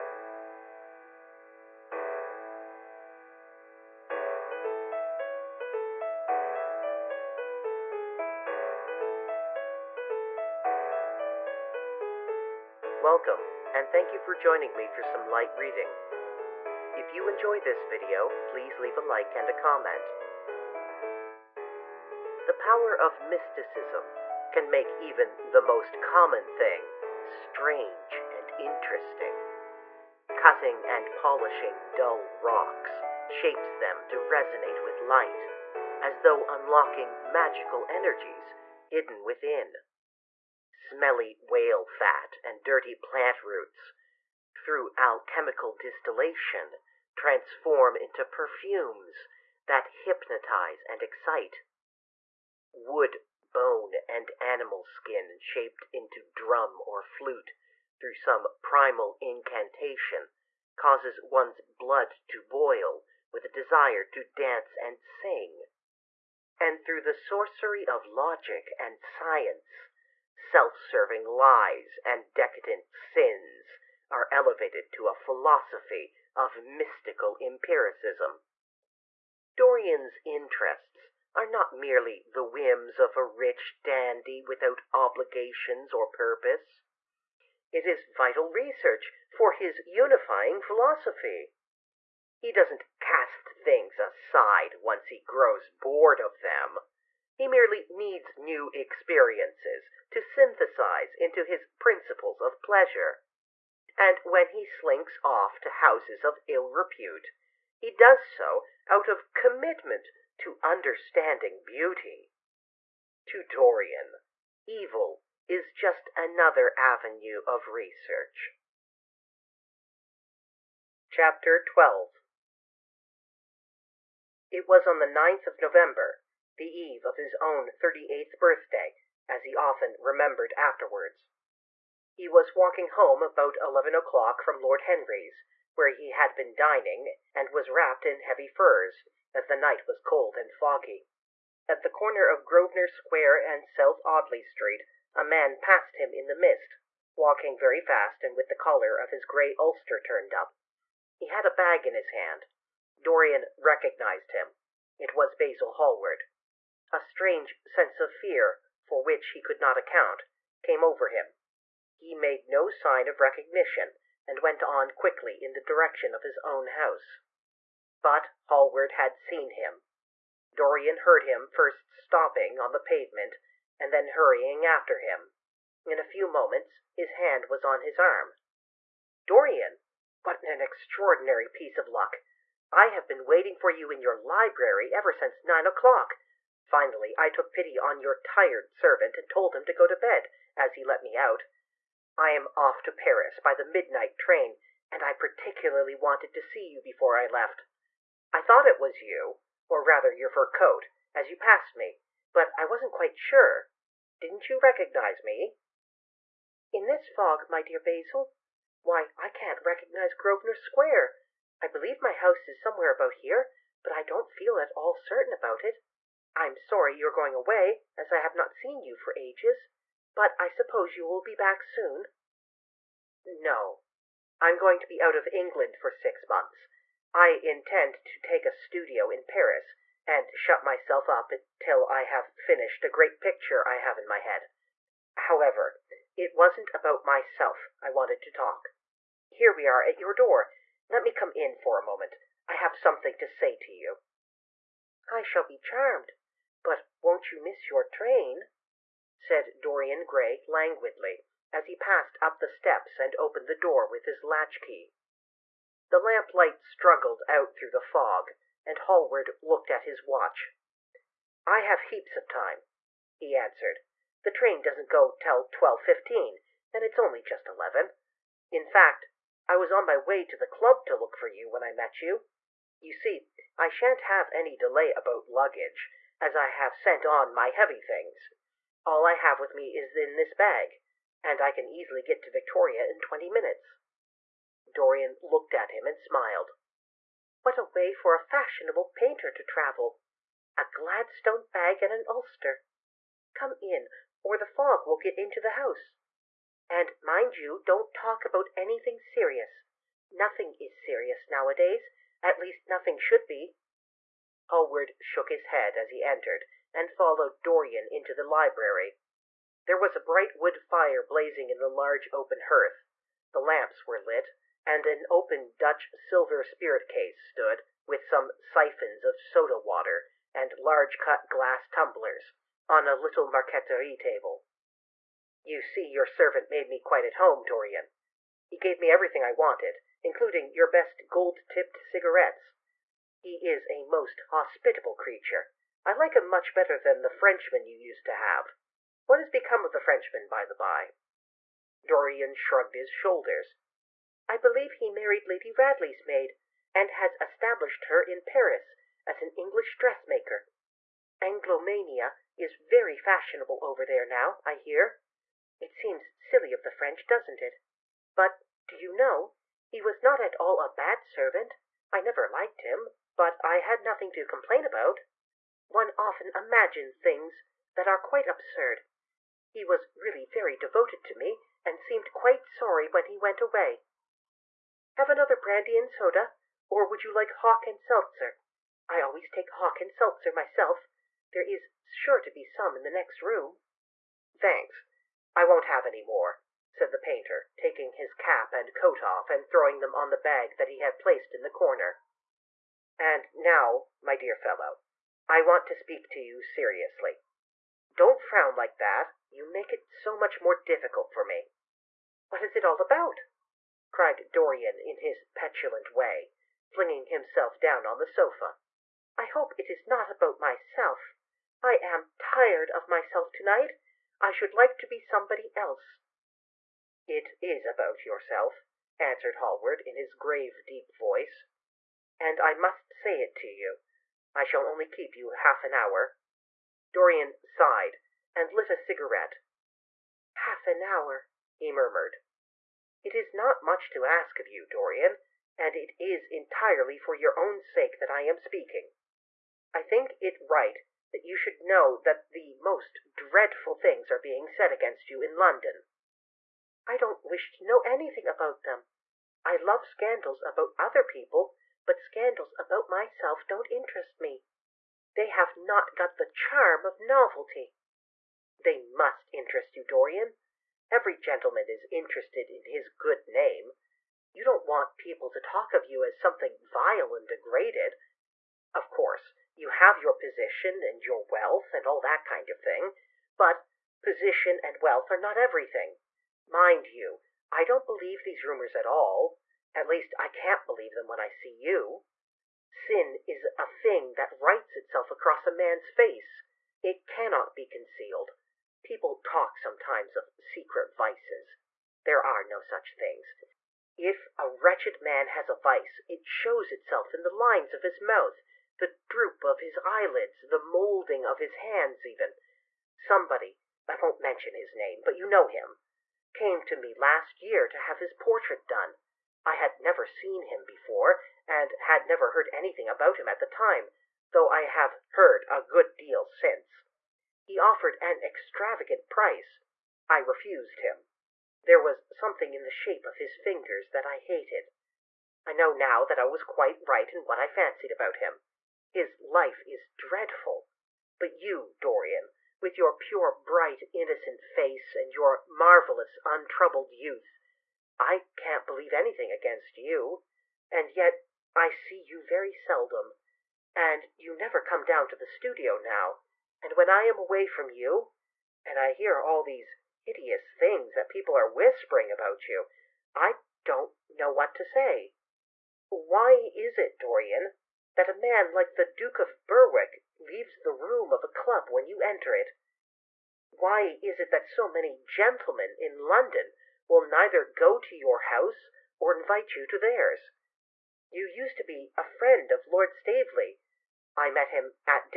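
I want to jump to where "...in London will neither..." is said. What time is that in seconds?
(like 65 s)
565 s.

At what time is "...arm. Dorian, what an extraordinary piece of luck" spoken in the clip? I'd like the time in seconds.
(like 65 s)
177 s.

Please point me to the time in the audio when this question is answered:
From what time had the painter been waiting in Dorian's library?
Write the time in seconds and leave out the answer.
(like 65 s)
185 s.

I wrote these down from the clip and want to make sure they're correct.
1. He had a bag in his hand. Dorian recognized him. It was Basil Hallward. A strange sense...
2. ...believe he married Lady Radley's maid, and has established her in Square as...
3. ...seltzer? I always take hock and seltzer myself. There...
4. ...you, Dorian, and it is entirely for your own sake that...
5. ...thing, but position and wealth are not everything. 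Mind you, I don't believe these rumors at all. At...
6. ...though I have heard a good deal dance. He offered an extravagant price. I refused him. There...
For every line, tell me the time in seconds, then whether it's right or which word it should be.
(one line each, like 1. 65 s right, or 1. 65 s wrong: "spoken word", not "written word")
1. 151 s right
2. 344 s wrong: "Paris", not "Square"
3. 377 s right
4. 434 s right
5. 472 s right
6. 514 s wrong: "since", not "dance".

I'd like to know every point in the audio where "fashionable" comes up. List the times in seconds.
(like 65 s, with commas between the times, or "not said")
288 s, 352 s.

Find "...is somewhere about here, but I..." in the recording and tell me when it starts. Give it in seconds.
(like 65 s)
212 s.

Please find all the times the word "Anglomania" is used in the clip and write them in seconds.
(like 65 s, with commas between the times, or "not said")
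351 s.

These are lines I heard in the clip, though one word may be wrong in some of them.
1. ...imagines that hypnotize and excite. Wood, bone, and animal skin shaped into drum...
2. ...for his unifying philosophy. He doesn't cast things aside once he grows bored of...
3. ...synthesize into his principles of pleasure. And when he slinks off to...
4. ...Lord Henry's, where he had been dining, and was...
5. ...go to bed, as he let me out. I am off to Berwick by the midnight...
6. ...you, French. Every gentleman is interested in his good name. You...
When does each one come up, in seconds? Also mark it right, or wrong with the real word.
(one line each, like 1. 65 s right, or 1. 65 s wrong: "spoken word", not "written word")
1. 48 s wrong: "perfumes", not "imagines"
2. 89 s right
3. 100 s right
4. 134 s right
5. 189 s wrong: "Paris", not "Berwick"
6. 459 s wrong: "Dorian", not "French".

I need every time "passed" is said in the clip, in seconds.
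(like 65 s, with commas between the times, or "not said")
145 s, 201 s, 251 s.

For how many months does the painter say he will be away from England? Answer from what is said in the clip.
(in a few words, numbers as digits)
6.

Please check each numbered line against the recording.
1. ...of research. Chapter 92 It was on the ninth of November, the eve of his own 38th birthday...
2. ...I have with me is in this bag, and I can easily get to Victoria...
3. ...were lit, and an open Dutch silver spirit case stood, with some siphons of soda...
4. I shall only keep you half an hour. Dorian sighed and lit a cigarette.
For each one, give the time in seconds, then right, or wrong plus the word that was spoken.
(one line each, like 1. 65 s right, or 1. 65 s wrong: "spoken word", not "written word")
1. 117 s wrong: "12", not "92"
2. 279 s right
3. 313 s right
4. 424 s right.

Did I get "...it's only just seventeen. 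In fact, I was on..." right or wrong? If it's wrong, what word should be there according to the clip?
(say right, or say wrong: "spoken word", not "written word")
wrong: "eleven", not "seventeen".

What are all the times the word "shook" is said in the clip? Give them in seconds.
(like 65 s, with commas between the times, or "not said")
305 s.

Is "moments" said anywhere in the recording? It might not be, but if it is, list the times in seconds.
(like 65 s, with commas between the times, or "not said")
176 s, 241 s.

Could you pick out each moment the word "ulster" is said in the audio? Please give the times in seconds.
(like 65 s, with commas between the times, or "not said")
149 s, 292 s.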